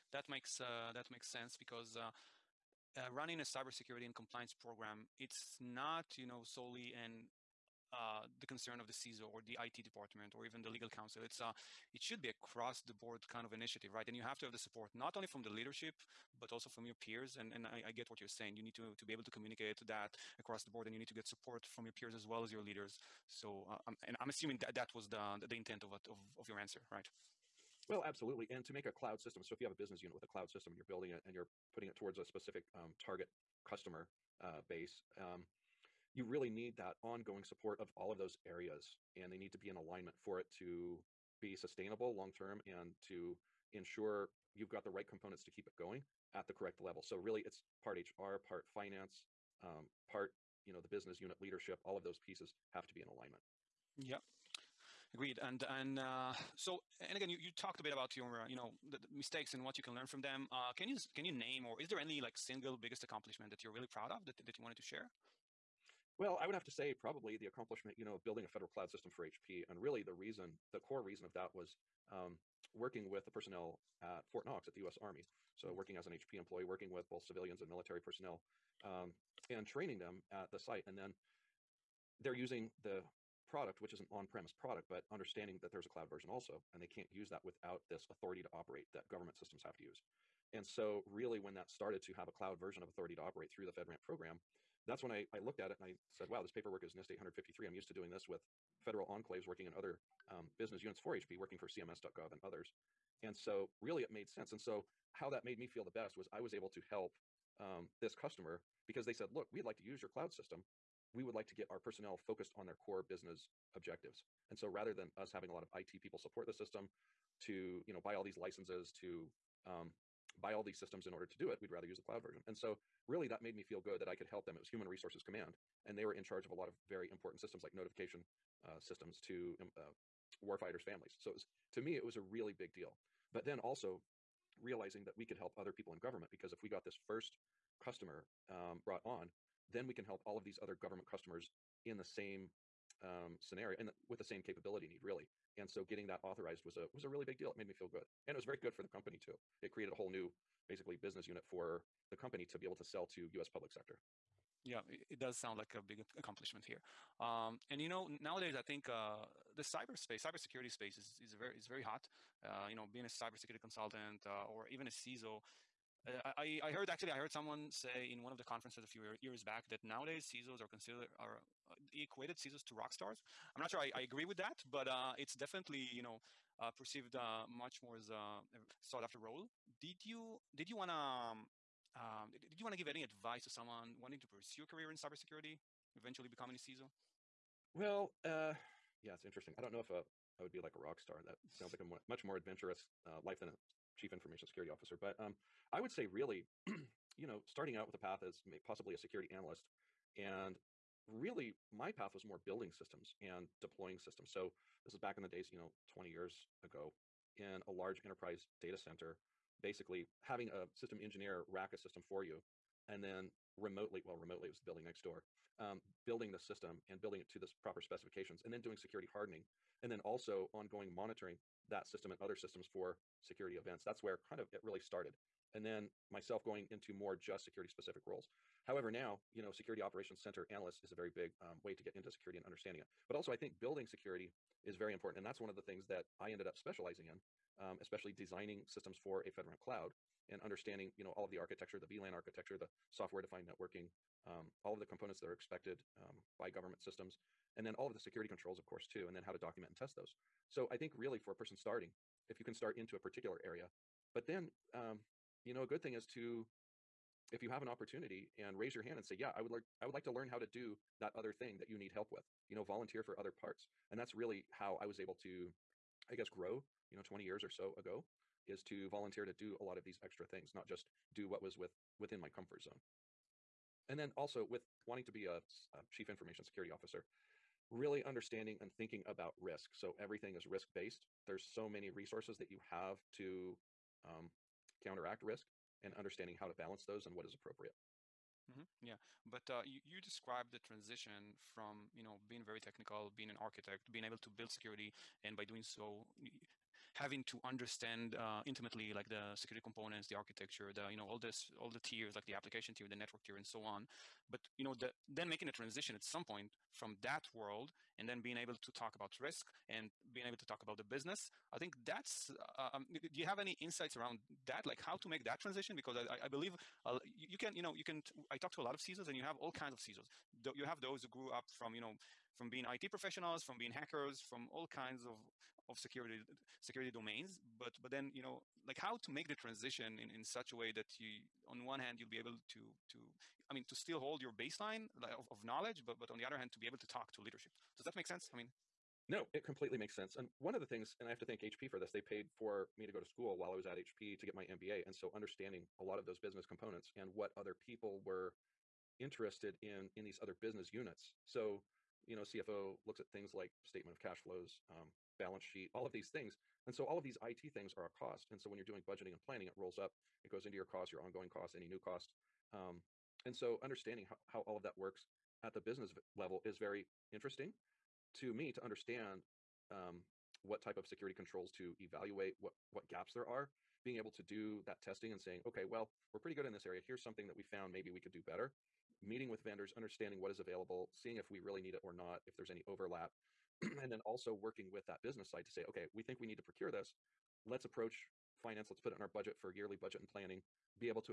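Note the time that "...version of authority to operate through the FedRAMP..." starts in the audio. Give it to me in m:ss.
1:32.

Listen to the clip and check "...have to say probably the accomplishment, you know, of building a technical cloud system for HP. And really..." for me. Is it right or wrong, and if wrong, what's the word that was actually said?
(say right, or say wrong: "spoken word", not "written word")
wrong: "federal", not "technical".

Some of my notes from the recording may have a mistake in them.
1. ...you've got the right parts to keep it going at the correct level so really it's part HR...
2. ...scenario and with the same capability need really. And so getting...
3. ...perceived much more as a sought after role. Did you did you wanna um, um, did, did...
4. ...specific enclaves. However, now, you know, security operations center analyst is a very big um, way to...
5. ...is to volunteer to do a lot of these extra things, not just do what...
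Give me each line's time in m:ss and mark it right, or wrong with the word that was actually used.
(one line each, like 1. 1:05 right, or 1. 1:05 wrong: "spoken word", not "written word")
1. 0:44 wrong: "components", not "parts"
2. 2:23 right
3. 2:56 right
4. 3:47 wrong: "roles", not "enclaves"
5. 4:28 right.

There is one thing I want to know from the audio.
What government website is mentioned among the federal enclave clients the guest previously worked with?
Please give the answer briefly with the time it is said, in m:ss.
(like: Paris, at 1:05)
CMS.gov, at 1:41.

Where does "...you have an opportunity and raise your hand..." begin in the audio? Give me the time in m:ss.
4:17.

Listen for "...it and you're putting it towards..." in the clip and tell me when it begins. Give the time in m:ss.
0:31.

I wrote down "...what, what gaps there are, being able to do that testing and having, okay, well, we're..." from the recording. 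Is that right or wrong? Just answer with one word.
wrong.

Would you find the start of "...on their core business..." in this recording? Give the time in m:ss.
1:52.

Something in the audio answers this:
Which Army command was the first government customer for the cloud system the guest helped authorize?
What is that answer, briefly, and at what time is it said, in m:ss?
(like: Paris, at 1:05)
Human Resources Command, at 2:04.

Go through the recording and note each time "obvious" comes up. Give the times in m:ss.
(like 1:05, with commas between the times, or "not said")
not said.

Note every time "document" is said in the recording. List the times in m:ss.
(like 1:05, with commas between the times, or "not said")
4:09.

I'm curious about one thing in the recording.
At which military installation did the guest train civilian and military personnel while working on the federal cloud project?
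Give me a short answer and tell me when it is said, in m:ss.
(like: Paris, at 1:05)
Fort Knox, at 1:14.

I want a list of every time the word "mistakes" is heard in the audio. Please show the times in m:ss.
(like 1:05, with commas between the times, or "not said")
0:59.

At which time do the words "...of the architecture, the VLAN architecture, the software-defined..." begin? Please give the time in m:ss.
4:01.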